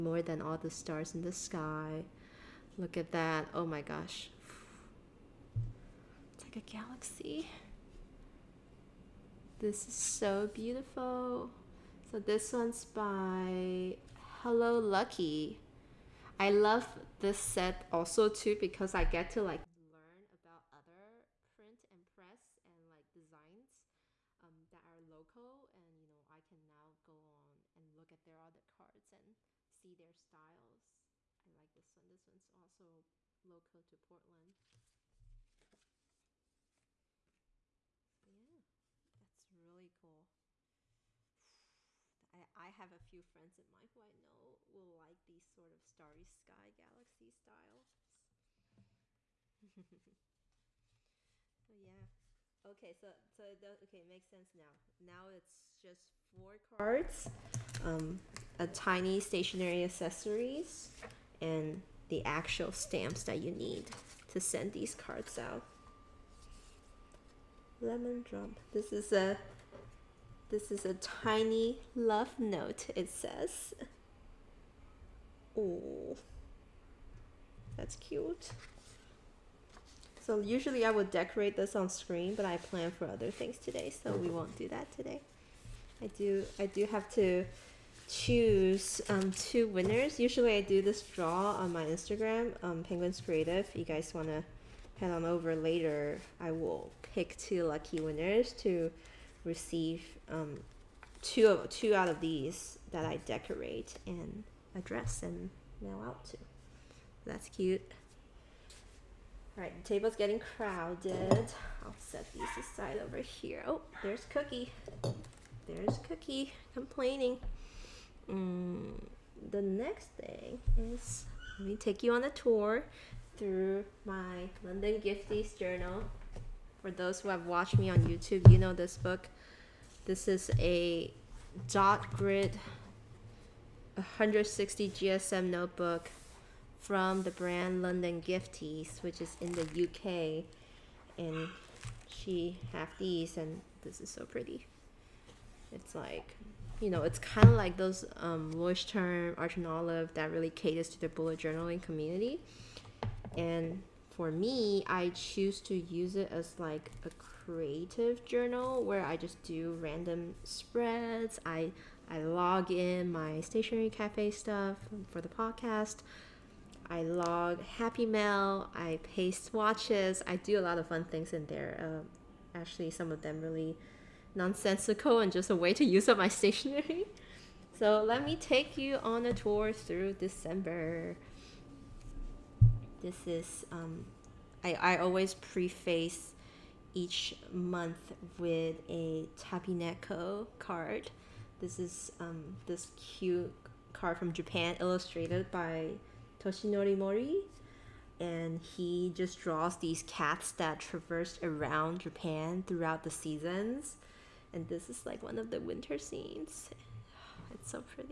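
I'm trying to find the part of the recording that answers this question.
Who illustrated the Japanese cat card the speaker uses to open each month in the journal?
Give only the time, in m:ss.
3:16.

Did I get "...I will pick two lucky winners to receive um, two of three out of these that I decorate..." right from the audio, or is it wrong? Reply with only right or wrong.
wrong.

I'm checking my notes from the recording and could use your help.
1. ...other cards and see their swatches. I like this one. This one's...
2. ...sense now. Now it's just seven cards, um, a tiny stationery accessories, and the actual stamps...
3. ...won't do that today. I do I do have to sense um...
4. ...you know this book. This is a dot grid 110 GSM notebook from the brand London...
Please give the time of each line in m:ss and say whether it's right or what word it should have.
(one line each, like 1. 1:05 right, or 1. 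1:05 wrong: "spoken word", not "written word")
1. 0:28 wrong: "styles", not "swatches"
2. 0:54 wrong: "four", not "seven"
3. 1:24 wrong: "choose", not "sense"
4. 2:08 wrong: "160", not "110".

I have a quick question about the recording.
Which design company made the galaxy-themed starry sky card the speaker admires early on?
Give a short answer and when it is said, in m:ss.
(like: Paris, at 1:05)
Hello Lucky, at 0:14.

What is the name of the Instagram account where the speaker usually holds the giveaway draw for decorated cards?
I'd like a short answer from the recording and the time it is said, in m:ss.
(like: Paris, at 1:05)
Penguins Creative, at 1:32.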